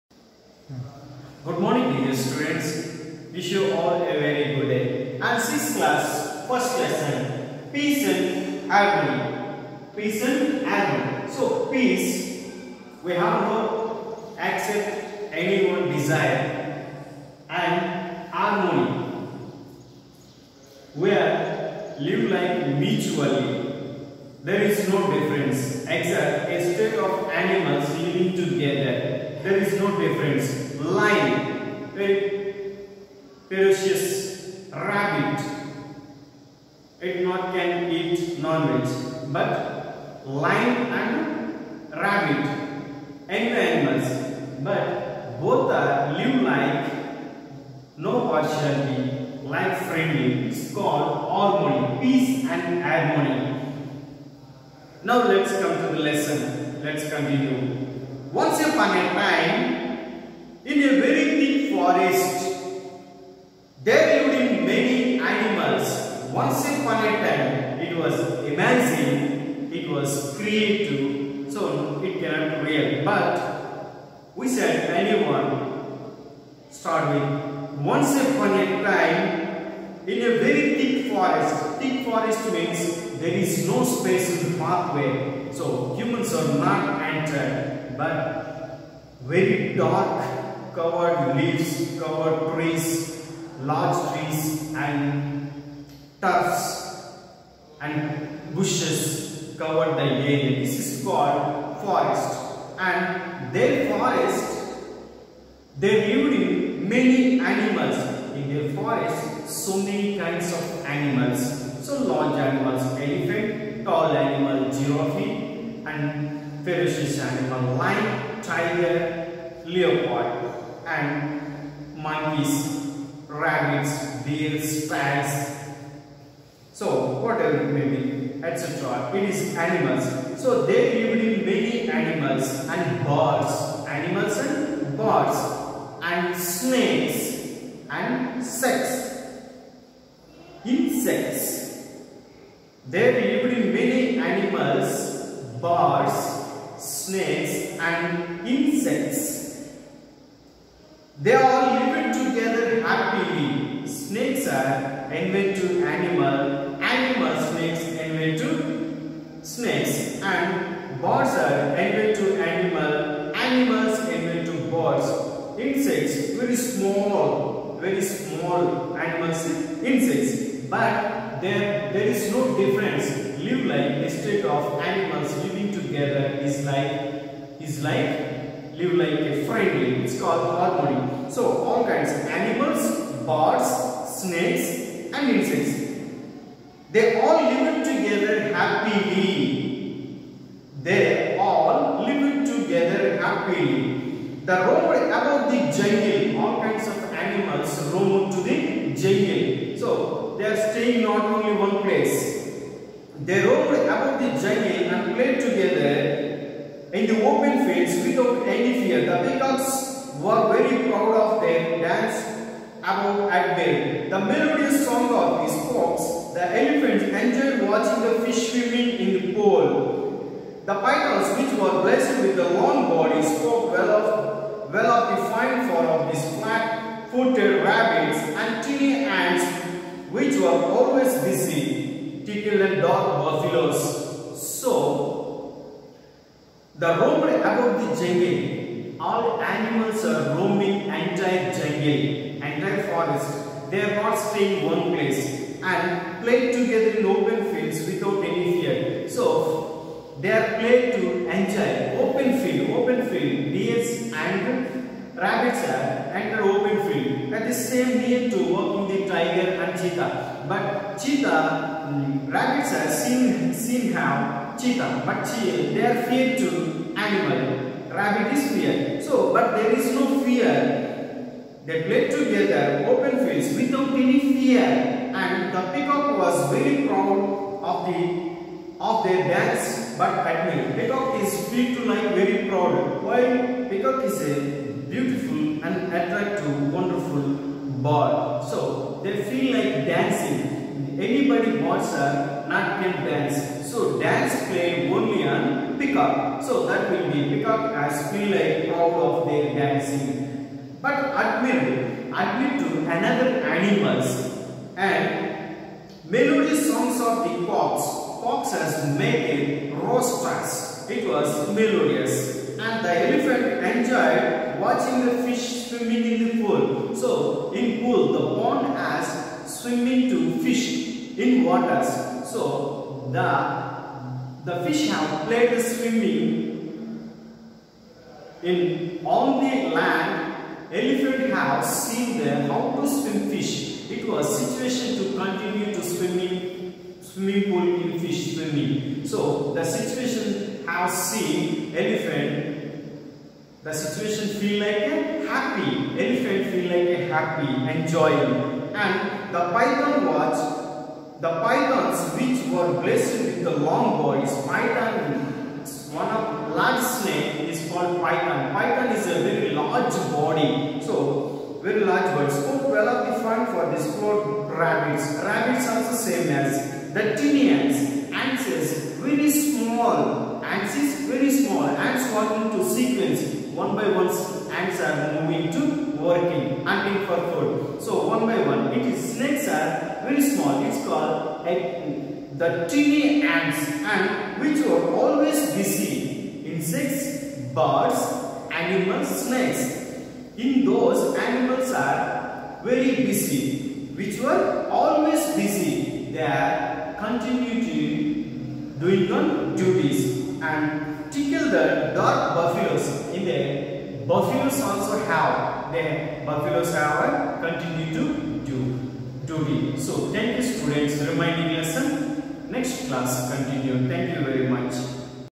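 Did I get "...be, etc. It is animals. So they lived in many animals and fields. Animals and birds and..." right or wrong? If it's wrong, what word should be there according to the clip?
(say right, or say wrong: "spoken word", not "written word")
wrong: "birds", not "fields".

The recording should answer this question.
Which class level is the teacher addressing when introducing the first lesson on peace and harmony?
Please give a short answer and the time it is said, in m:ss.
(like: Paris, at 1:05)
Sixth class, at 0:05.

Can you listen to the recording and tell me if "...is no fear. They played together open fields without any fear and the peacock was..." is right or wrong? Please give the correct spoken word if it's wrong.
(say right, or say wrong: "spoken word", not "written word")
right.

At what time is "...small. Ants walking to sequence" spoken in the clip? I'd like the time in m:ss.
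6:11.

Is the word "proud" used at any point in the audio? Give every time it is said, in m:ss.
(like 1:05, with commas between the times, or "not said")
3:30, 4:36, 4:42, 4:58.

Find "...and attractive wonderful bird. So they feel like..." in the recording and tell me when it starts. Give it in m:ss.
4:45.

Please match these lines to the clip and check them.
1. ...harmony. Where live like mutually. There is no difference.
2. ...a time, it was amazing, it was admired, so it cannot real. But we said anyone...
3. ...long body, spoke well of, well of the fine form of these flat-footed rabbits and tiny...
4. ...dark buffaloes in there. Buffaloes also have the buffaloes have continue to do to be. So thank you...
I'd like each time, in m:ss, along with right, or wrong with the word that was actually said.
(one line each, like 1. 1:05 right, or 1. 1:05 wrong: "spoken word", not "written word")
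1. 0:18 right
2. 1:07 wrong: "created", not "admired"
3. 3:42 right
4. 6:41 right.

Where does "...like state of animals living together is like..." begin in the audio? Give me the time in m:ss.
2:53.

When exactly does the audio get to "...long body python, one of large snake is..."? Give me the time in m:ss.
5:53.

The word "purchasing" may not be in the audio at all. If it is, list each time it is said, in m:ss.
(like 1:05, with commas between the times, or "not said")
not said.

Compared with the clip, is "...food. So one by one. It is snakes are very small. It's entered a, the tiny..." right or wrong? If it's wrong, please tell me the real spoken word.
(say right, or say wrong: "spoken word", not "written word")
wrong: "called", not "entered".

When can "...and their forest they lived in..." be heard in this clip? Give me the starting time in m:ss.
1:42.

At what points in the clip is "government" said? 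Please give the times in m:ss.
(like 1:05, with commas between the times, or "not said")
not said.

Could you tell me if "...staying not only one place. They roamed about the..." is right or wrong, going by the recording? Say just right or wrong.
right.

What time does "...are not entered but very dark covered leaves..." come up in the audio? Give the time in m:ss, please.
1:26.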